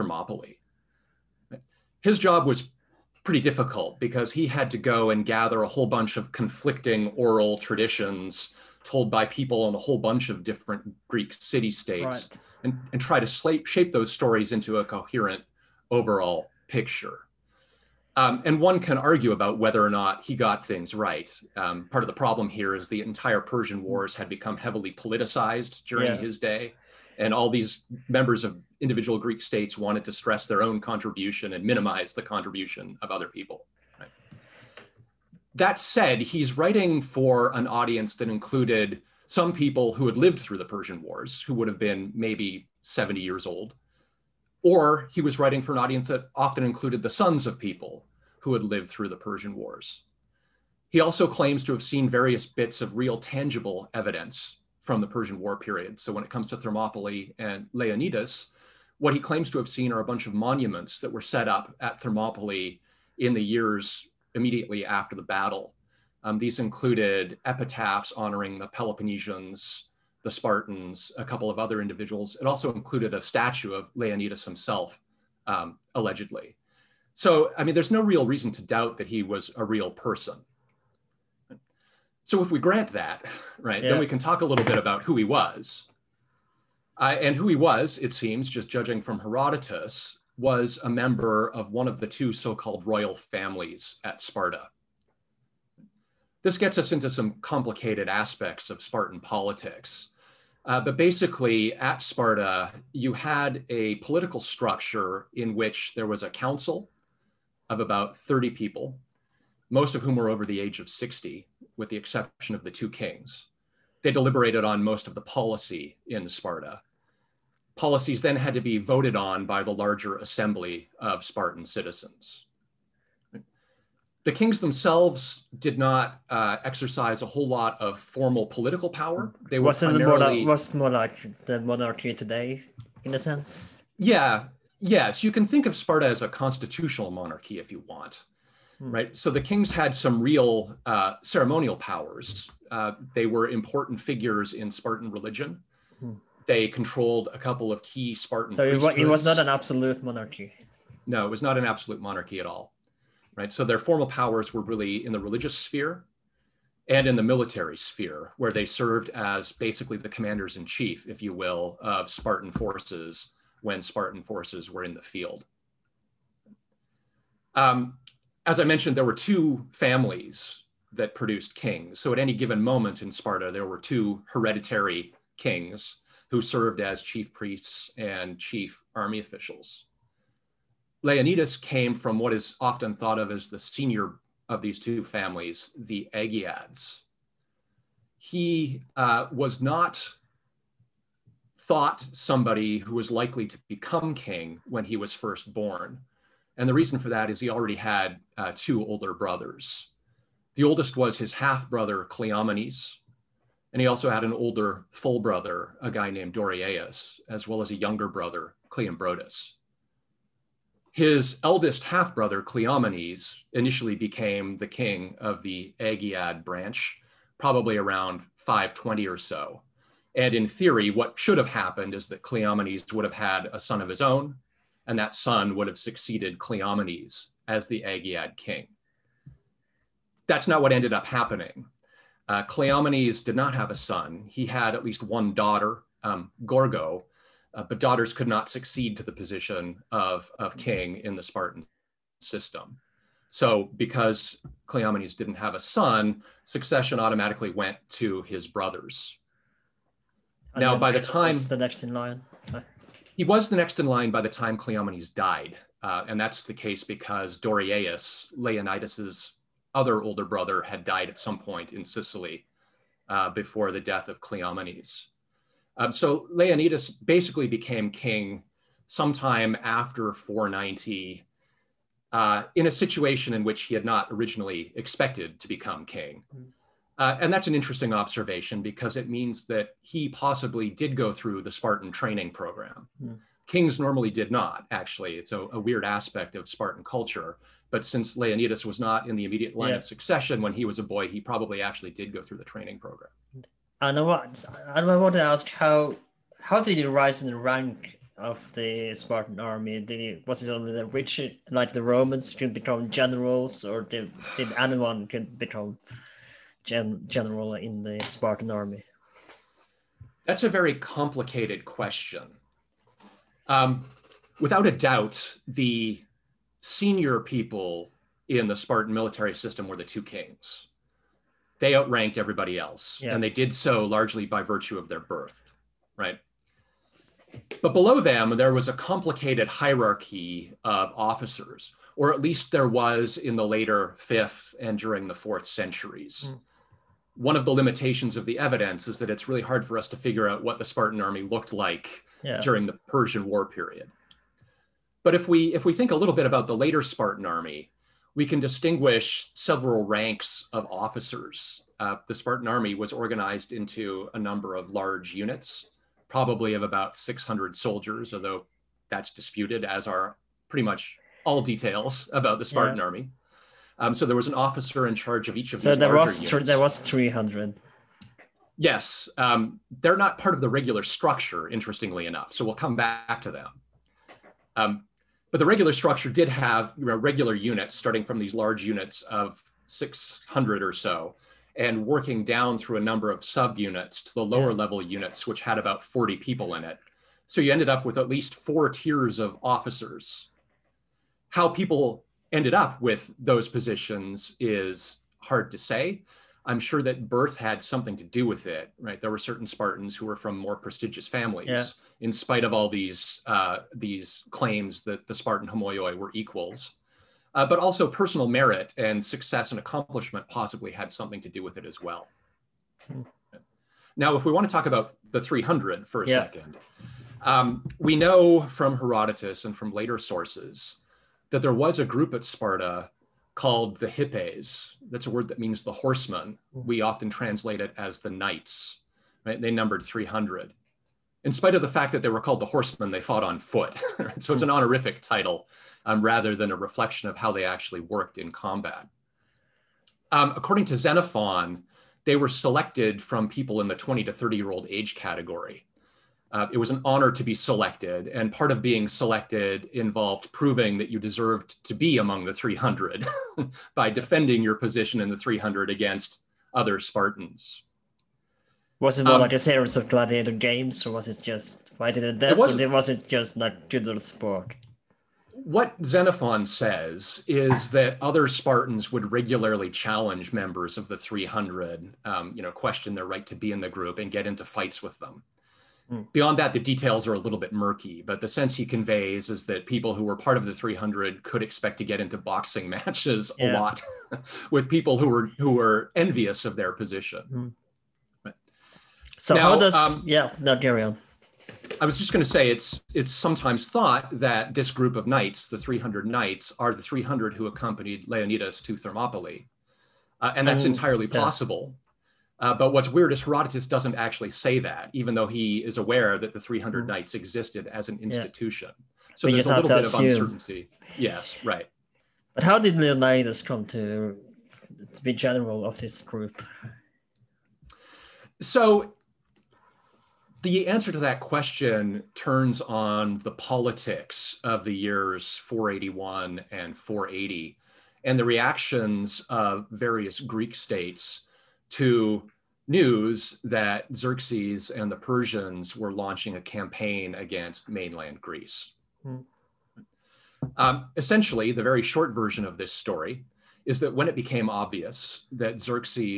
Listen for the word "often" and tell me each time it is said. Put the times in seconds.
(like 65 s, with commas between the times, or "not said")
46 s, 182 s, 426 s.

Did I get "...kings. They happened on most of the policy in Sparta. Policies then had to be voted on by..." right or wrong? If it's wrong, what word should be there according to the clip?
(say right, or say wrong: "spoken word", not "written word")
wrong: "deliberated", not "happened".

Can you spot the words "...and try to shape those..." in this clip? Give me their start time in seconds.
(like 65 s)
12 s.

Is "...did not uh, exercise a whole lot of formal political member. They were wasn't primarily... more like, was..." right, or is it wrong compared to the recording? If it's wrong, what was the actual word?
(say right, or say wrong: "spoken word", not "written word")
wrong: "power", not "member".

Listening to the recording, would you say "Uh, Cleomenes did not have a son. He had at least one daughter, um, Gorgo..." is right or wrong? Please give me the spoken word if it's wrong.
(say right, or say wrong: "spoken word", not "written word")
right.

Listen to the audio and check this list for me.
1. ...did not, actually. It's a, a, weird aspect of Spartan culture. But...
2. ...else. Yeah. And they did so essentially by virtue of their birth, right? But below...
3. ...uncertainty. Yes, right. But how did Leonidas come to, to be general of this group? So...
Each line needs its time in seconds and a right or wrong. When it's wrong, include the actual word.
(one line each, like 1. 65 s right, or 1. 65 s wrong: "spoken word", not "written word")
1. 284 s right
2. 322 s wrong: "largely", not "essentially"
3. 510 s right.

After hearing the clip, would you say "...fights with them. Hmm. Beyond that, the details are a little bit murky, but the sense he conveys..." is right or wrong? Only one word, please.
right.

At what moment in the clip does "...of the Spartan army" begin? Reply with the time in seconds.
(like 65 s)
298 s.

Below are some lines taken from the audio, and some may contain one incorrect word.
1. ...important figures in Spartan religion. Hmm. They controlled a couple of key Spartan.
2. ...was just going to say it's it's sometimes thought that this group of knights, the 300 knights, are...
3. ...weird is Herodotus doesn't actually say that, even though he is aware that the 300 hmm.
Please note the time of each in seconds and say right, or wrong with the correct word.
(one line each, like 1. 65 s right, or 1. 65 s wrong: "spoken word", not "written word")
1. 143 s right
2. 491 s right
3. 502 s right.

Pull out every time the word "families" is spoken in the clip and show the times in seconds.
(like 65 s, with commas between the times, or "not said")
93 s, 169 s, 185 s, 401 s.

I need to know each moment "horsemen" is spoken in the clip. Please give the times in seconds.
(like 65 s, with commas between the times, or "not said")
425 s, 432 s.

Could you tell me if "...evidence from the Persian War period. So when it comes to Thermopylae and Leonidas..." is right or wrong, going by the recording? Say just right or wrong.
right.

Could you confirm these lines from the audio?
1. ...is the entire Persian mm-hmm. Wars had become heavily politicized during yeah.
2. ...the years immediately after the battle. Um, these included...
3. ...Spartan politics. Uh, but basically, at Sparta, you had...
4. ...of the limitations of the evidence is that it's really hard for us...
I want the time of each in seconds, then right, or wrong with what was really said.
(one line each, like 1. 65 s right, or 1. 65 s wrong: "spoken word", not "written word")
1. 22 s right
2. 63 s right
3. 98 s right
4. 337 s right.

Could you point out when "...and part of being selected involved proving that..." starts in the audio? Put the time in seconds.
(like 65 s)
448 s.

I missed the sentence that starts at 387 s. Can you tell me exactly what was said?
So you ended up with at least four tiers of officers.